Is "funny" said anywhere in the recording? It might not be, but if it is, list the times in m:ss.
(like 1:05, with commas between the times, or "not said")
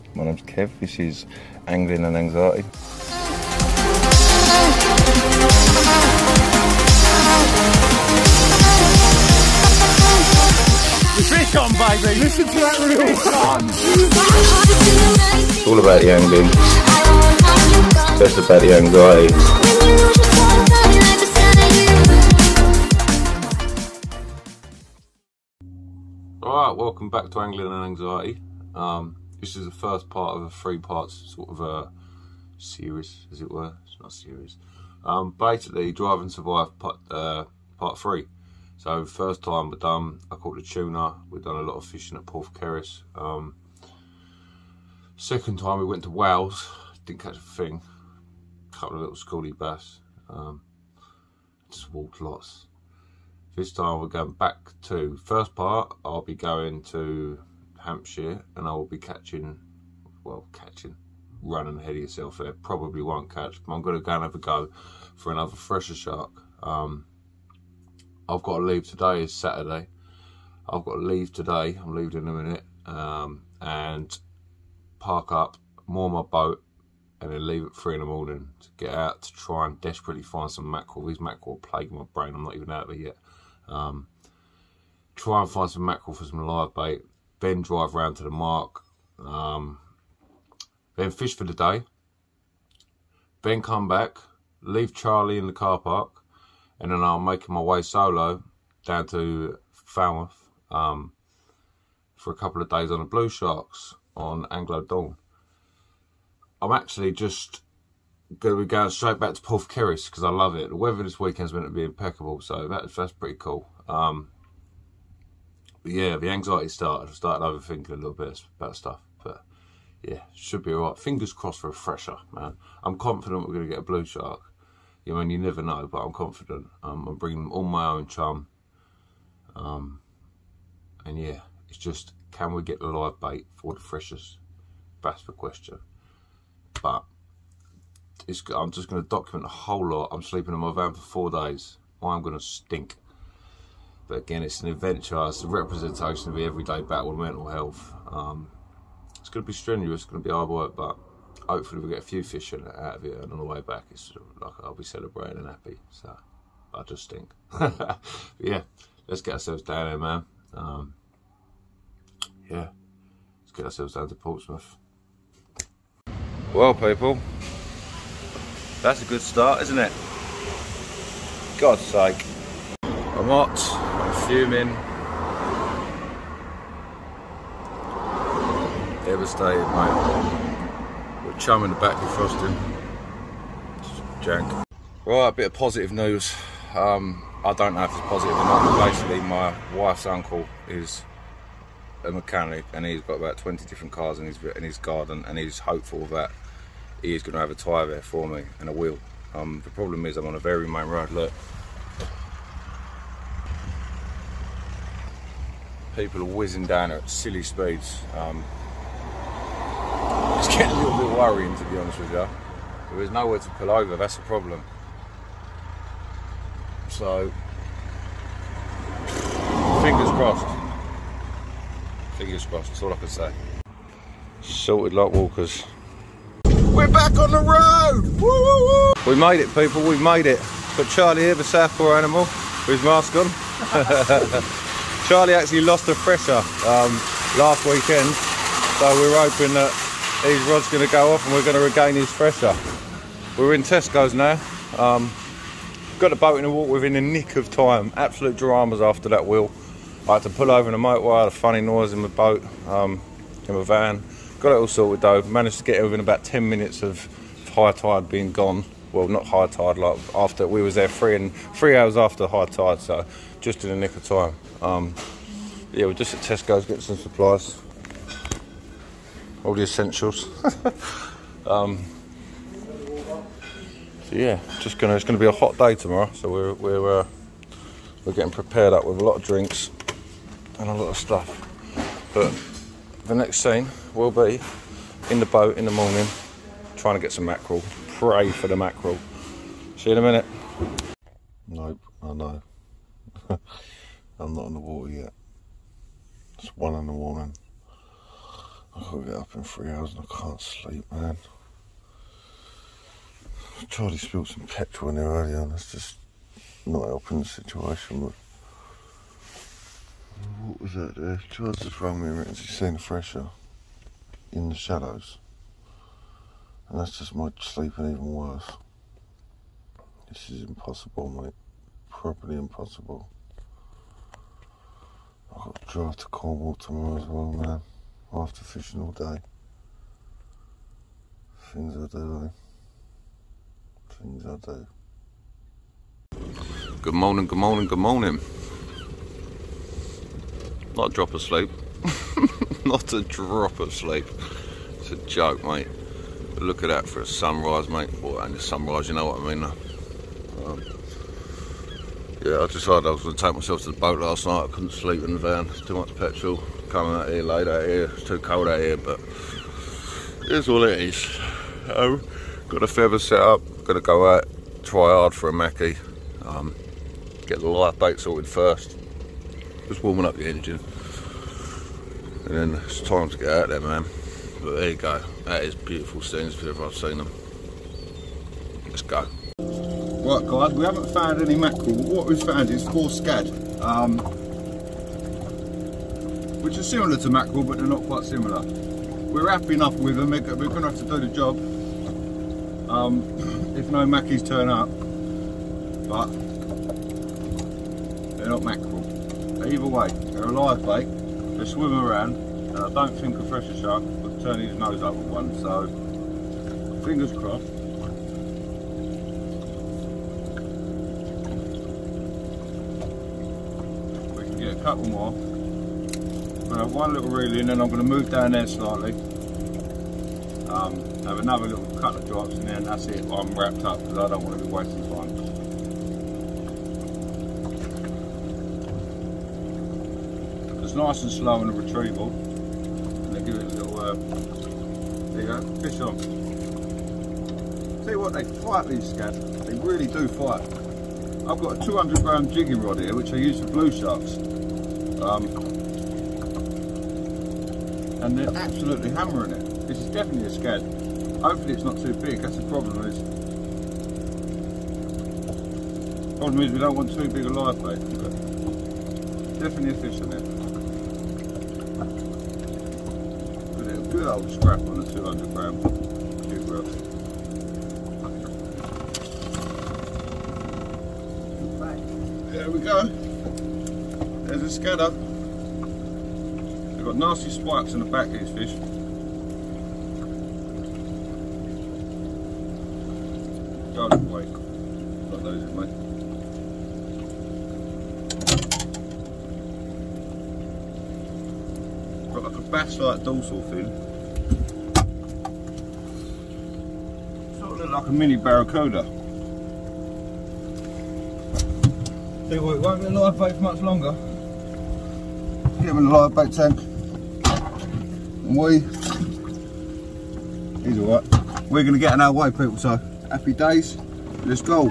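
4:11.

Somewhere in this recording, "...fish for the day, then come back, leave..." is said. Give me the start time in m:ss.
1:31.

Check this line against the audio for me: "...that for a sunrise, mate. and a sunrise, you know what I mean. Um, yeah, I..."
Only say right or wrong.
right.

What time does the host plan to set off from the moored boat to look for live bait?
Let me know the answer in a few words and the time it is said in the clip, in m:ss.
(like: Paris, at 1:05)
3 in the morning, at 1:17.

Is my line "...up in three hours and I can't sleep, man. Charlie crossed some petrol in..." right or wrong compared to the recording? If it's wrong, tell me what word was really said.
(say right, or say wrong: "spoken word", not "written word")
wrong: "spilled", not "crossed".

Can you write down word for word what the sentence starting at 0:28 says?
Um, this is the first part of a three parts sort of a uh, series, as it were.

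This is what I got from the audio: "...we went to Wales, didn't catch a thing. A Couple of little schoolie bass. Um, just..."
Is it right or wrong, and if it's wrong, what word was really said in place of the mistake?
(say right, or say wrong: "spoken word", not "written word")
right.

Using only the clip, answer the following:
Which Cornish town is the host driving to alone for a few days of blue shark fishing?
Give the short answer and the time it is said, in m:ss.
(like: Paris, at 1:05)
Falmouth, at 1:39.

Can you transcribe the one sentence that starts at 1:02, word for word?
Probably won't catch, but I'm going to go and have a go for another fresher shark.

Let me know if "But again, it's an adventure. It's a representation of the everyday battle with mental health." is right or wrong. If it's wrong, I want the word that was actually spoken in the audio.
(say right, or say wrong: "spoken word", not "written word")
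right.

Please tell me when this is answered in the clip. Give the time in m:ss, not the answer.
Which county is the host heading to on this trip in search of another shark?
0:57.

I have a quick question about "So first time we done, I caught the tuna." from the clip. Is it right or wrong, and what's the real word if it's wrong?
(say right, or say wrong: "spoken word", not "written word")
right.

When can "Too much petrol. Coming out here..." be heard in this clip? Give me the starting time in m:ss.
5:55.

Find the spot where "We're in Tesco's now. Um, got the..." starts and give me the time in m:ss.
4:03.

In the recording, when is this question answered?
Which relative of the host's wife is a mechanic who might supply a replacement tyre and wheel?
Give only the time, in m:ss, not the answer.
3:10.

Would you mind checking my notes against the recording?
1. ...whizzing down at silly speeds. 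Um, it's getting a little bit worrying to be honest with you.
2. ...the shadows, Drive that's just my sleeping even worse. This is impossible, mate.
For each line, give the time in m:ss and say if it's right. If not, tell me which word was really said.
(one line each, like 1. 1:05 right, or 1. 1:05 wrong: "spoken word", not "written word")
1. 3:26 right
2. 5:14 wrong: "And", not "Drive".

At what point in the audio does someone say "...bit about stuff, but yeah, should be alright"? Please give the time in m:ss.
1:58.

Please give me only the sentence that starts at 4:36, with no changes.
So we're we're uh, we're getting prepared up with a lot of drinks and a lot of stuff.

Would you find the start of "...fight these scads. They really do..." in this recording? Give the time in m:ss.
7:18.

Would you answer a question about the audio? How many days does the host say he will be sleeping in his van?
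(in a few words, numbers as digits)
4.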